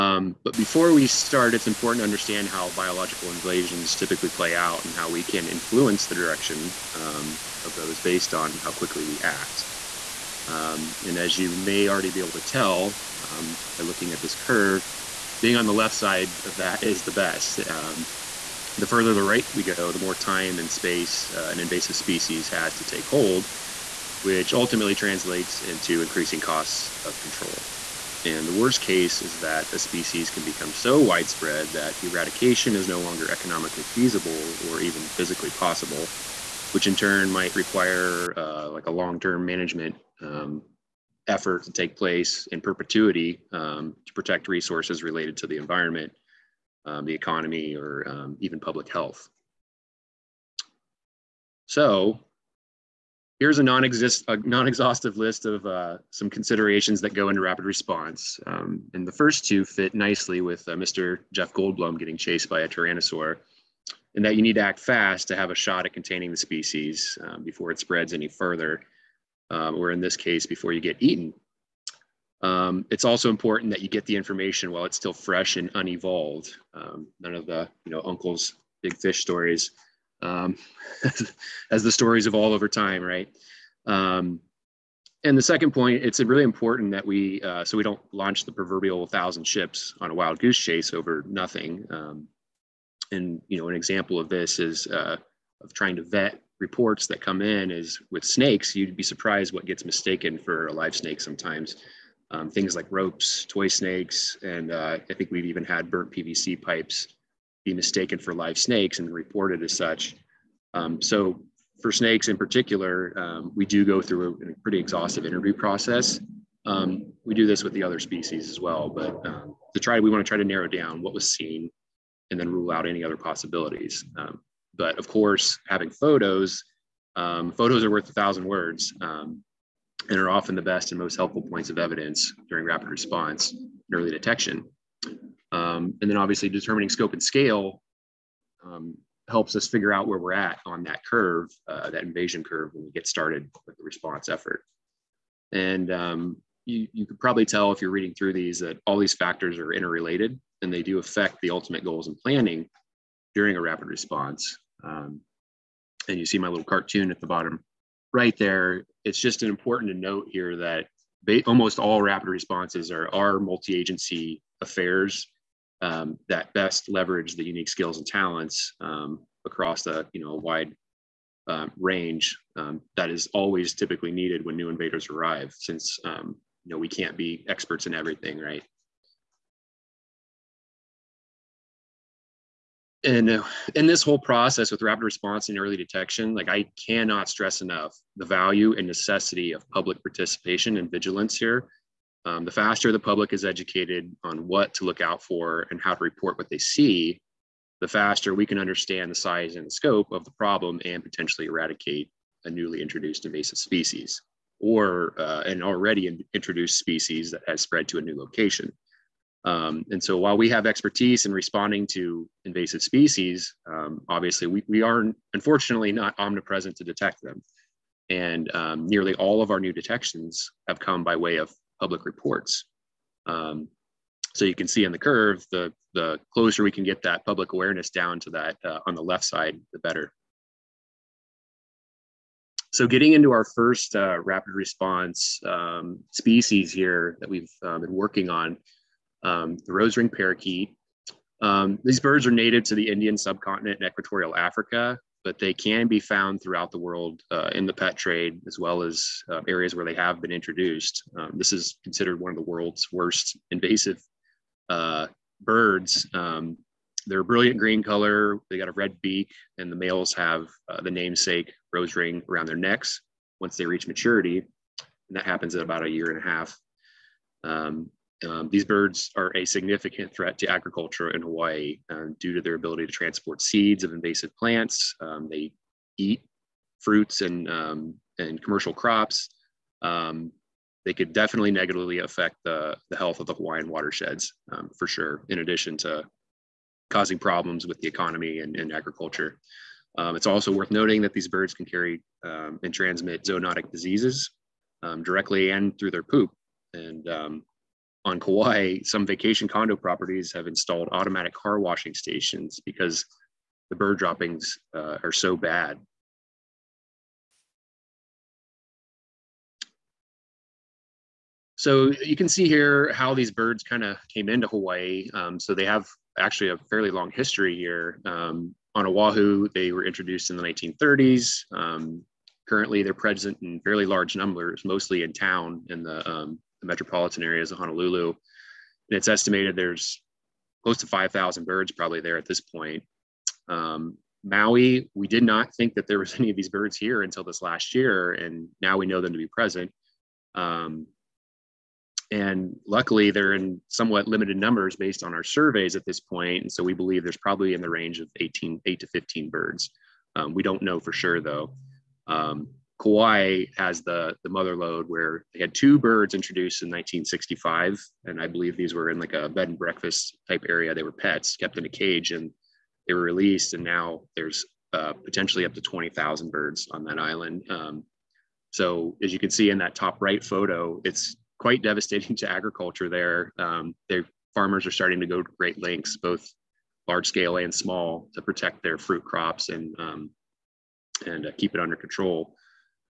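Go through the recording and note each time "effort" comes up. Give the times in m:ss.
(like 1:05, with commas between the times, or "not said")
0:41, 2:24.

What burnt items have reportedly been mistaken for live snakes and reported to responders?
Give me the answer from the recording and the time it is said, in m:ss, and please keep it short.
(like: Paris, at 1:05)
PVC pipes, at 1:46.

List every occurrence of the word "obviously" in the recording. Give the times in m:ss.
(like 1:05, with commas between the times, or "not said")
2:16, 3:34.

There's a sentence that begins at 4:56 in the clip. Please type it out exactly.
And on Kauai, some vacation condo properties have installed automatic car washing stations because the bird droppings uh, are so bad.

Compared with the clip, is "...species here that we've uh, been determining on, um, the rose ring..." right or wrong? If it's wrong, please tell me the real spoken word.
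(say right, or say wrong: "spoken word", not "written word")
wrong: "working", not "determining".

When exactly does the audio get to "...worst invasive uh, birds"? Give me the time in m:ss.
4:12.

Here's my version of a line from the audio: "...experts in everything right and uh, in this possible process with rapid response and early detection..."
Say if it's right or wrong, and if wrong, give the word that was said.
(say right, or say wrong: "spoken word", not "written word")
wrong: "whole", not "possible".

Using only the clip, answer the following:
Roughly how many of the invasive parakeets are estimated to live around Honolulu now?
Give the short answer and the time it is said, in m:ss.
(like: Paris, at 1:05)
5,000, at 5:30.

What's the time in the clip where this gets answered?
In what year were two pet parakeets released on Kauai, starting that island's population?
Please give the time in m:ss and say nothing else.
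5:56.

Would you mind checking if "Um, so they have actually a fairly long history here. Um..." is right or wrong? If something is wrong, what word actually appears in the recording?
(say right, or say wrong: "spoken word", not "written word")
right.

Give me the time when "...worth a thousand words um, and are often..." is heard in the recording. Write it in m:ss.
2:07.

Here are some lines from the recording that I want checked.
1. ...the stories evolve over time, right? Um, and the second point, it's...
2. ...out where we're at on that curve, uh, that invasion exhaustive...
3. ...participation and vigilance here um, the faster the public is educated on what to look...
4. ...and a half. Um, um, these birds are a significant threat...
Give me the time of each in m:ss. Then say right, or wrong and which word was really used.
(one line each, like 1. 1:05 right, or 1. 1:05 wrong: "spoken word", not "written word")
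1. 1:21 right
2. 2:19 wrong: "curve", not "exhaustive"
3. 3:10 right
4. 4:26 right.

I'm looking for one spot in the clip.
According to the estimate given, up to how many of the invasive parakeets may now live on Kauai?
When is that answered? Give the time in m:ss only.
6:05.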